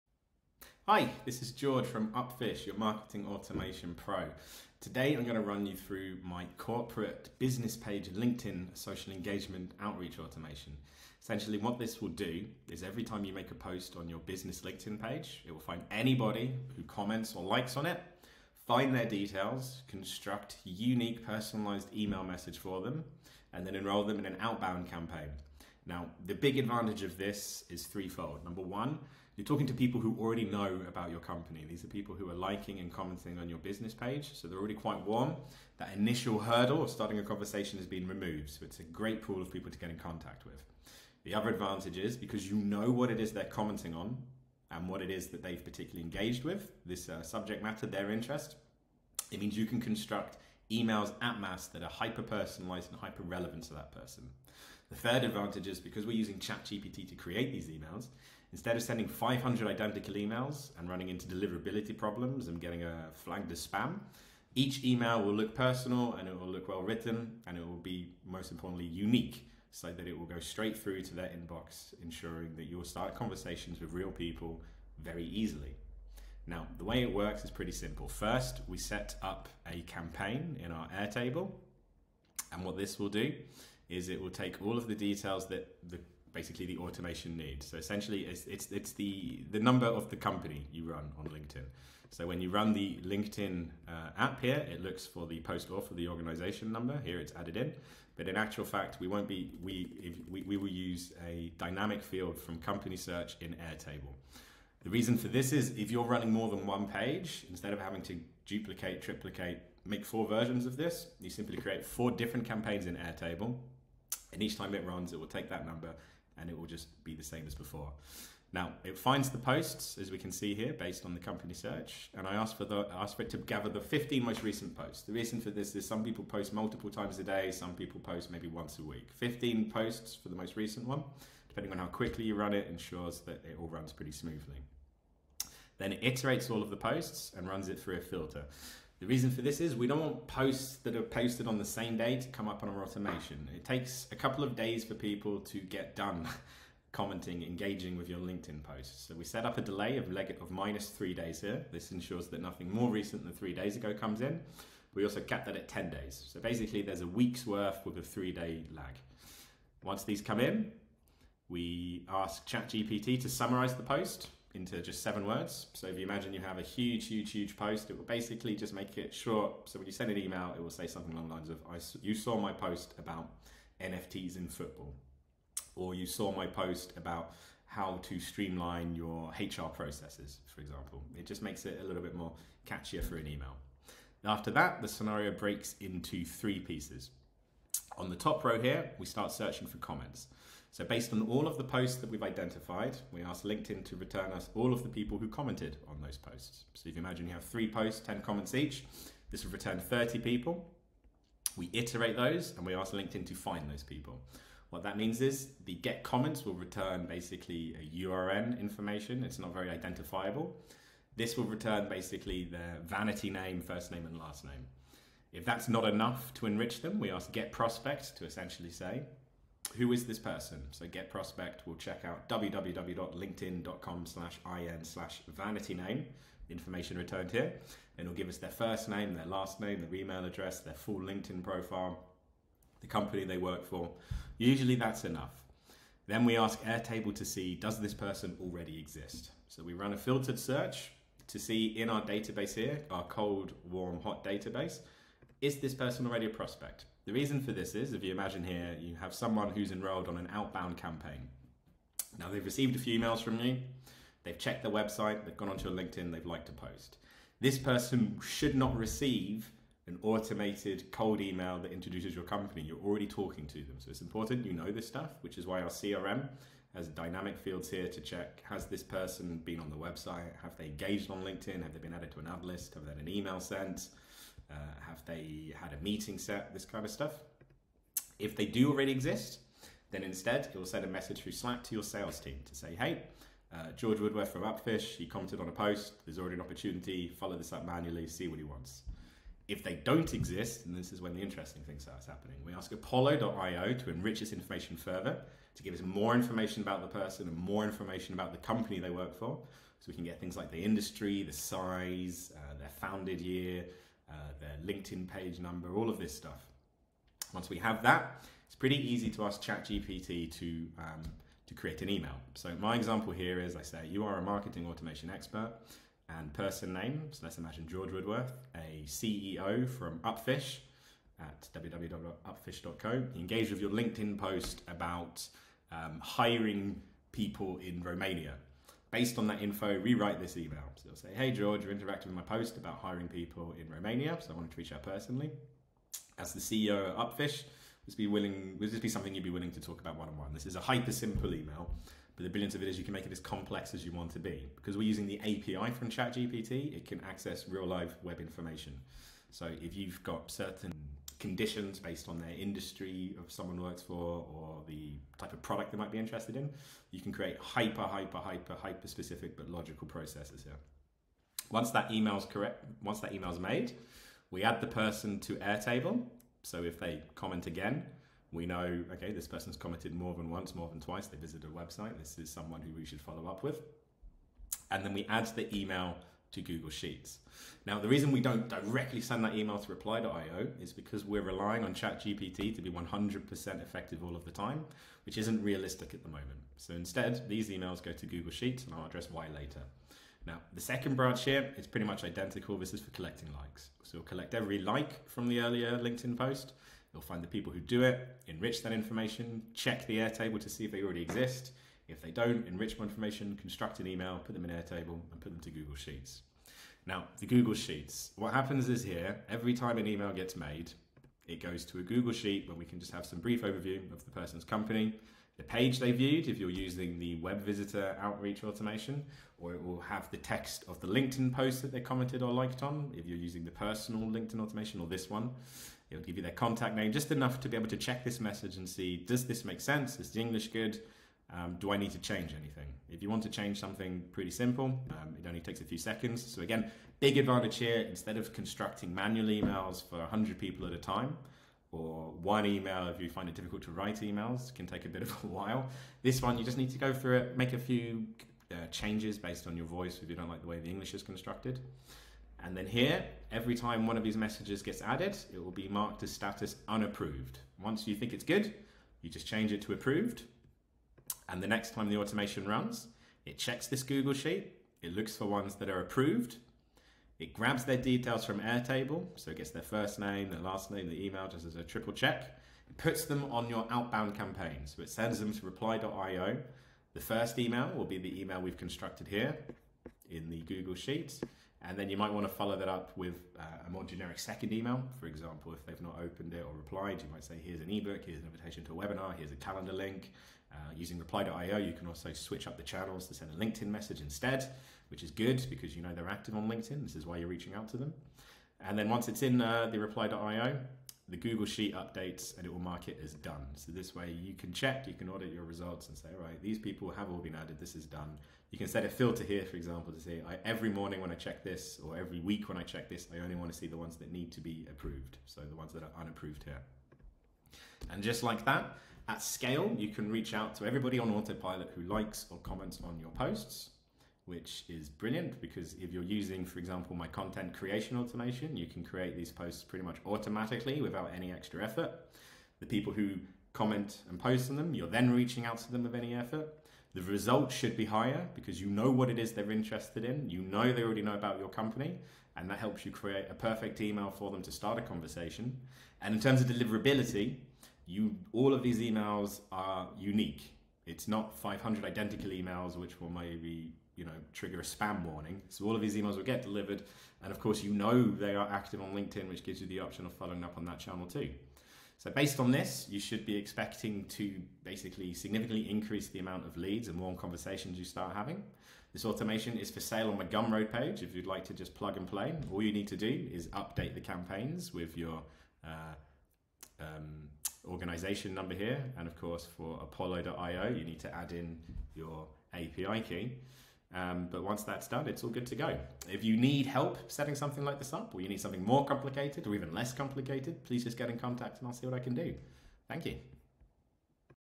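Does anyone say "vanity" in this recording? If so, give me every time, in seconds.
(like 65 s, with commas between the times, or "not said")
212 s, 225 s.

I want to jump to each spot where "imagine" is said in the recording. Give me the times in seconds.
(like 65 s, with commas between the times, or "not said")
166 s, 197 s, 248 s, 317 s.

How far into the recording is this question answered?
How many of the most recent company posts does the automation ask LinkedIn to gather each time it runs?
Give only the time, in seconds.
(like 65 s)
123 s.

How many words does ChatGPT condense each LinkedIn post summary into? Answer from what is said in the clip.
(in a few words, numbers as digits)
7.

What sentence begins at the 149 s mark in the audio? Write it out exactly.
So we set up a delay of, leg- of minus three days here.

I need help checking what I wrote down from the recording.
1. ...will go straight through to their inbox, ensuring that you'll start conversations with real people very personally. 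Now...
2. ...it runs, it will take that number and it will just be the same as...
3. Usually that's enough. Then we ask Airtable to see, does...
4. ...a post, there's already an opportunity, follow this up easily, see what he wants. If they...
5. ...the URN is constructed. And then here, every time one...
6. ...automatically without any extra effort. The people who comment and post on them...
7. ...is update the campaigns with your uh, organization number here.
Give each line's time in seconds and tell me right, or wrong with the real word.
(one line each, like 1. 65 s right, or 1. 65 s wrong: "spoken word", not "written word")
1. 70 s wrong: "easily", not "personally"
2. 114 s right
3. 234 s right
4. 285 s wrong: "manually", not "easily"
5. 450 s wrong: "English", not "URN"
6. 530 s right
7. 573 s right.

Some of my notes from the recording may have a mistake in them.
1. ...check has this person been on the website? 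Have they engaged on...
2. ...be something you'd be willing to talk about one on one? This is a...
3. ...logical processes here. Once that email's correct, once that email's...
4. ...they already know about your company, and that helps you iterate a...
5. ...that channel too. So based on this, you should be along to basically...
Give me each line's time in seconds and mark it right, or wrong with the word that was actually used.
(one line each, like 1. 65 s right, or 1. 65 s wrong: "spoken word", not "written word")
1. 268 s right
2. 338 s right
3. 359 s right
4. 540 s wrong: "create", not "iterate"
5. 560 s wrong: "expecting", not "along".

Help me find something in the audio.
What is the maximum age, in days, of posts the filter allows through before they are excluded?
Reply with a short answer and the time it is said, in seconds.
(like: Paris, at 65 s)
10 days, at 155 s.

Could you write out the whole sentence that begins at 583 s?
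Um, but once that's done, it's all good to go.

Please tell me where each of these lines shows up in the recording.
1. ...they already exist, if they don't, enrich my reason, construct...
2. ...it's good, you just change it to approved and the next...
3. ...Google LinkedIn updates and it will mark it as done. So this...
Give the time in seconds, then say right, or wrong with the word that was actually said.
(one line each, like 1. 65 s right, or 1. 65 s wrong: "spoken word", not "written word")
1. 400 s wrong: "information", not "reason"
2. 458 s right
3. 501 s wrong: "Sheet", not "LinkedIn".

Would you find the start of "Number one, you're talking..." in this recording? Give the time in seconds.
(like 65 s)
28 s.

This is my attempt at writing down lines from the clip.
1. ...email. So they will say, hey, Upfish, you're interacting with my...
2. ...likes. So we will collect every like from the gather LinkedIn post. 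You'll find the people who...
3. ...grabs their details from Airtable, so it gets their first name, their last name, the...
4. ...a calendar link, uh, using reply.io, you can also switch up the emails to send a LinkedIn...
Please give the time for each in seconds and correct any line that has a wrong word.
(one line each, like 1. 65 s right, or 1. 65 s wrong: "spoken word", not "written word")
1. 330 s wrong: "George", not "Upfish"
2. 393 s wrong: "earlier", not "gather"
3. 467 s right
4. 489 s wrong: "channels", not "emails".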